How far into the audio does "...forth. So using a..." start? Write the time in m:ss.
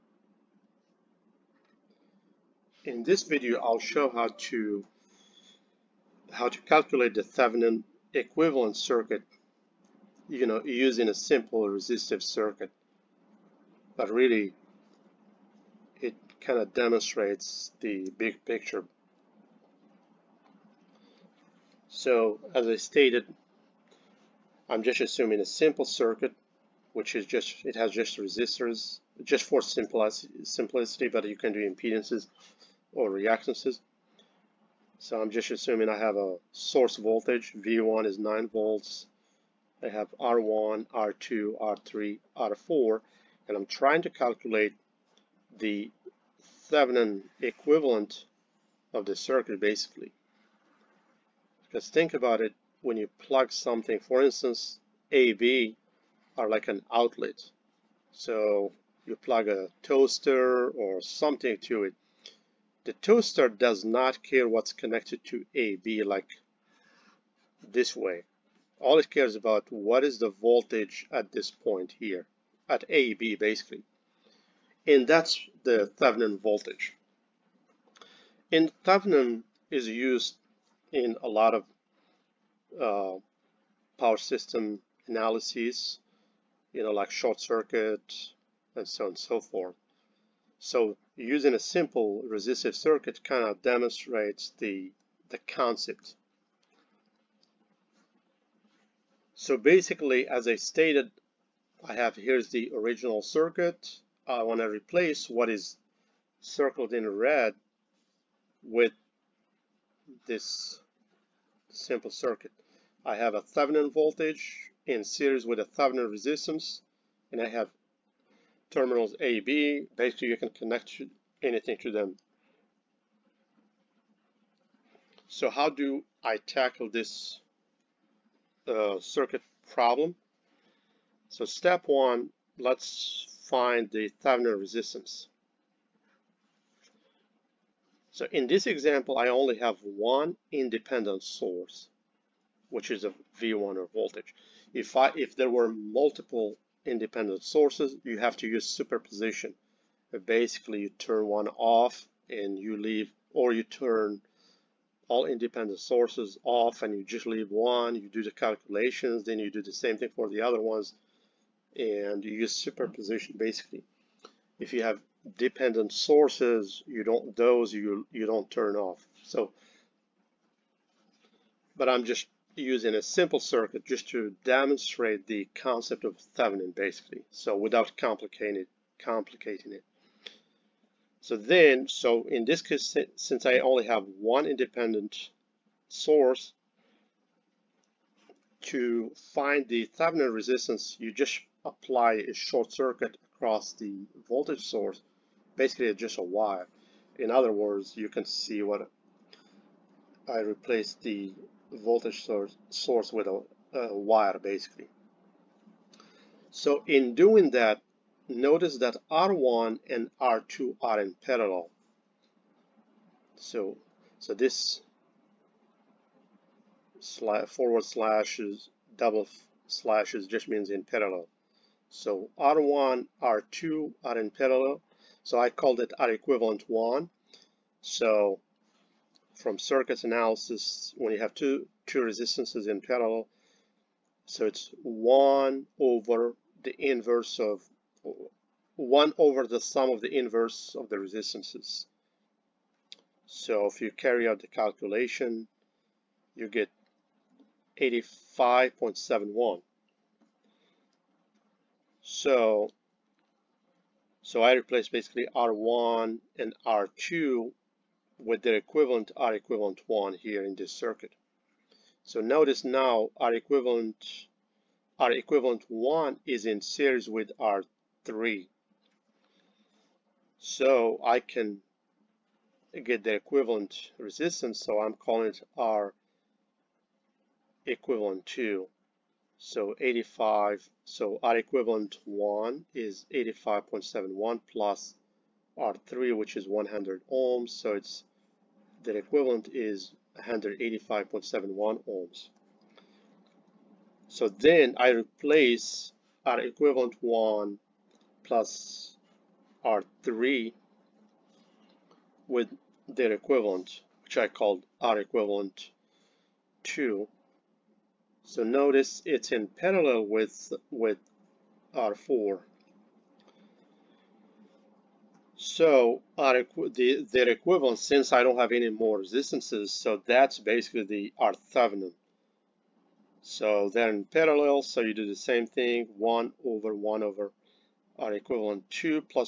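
1:29.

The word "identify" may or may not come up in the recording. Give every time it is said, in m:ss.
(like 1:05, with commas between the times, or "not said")
not said.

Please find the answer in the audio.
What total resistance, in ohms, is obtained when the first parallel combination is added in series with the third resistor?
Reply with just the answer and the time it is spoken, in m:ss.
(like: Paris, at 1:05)
185.71 ohms, at 4:50.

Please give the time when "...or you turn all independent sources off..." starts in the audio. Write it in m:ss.
2:33.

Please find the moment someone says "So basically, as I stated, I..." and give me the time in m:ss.
1:39.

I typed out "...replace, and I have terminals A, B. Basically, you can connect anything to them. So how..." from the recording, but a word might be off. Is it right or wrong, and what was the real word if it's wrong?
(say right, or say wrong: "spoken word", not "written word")
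wrong: "resistance", not "replace".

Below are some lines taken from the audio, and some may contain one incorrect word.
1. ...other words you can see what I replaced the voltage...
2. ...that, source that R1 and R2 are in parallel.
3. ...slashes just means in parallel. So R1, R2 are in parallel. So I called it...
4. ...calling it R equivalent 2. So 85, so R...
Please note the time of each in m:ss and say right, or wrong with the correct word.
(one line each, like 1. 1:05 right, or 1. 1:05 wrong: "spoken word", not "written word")
1. 3:17 right
2. 3:27 wrong: "notice", not "source"
3. 3:39 right
4. 4:34 right.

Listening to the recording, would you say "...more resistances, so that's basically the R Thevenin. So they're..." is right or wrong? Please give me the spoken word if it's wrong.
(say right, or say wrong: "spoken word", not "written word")
right.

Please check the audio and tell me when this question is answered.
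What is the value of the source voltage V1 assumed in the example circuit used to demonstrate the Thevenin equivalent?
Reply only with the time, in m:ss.
0:38.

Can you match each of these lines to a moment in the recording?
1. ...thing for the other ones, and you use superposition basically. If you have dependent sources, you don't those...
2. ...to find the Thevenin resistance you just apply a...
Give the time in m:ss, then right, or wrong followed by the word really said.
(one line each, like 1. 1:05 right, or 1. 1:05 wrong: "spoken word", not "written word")
1. 2:39 right
2. 3:08 right.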